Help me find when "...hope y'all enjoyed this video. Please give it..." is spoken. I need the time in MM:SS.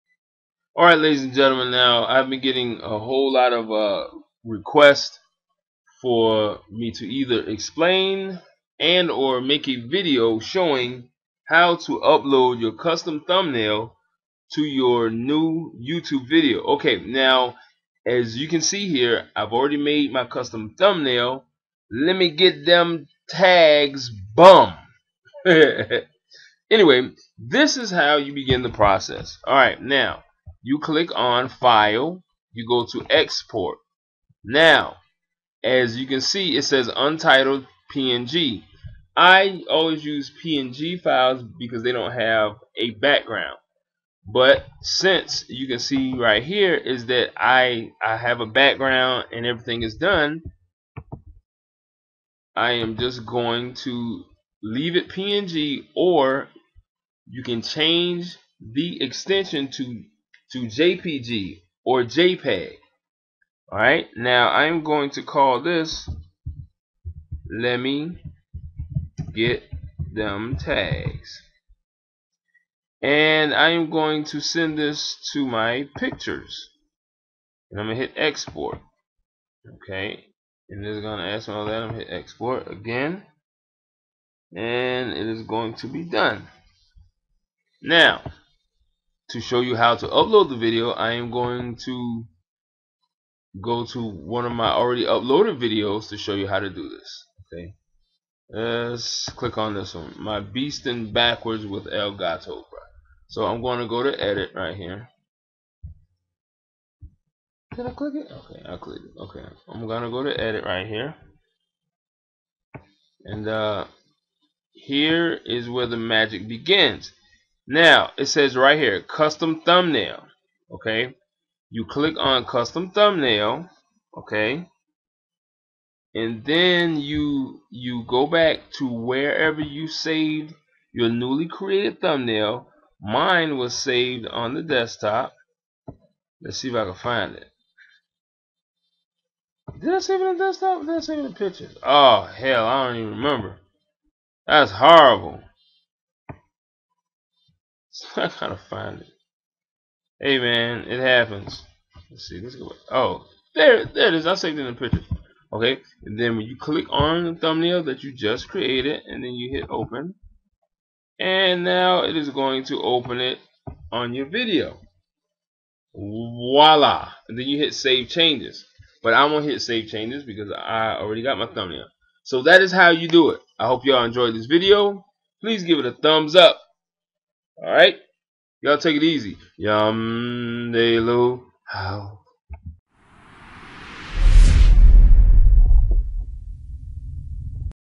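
02:53.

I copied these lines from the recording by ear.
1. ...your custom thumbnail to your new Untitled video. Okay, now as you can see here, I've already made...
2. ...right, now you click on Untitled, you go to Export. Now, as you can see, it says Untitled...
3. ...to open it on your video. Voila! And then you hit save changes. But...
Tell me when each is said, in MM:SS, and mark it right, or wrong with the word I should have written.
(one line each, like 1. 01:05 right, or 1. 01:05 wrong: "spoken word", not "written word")
1. 00:12 wrong: "YouTube", not "Untitled"
2. 00:29 wrong: "File", not "Untitled"
3. 02:42 right.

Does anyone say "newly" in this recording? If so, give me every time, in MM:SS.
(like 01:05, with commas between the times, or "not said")
02:11.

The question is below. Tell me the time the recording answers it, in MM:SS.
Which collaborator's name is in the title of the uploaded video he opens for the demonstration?
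01:41.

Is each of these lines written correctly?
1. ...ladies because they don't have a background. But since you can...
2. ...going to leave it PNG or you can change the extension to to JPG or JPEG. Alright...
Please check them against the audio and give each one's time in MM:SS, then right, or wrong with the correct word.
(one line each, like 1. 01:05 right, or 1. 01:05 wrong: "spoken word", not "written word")
1. 00:41 wrong: "files", not "ladies"
2. 00:53 right.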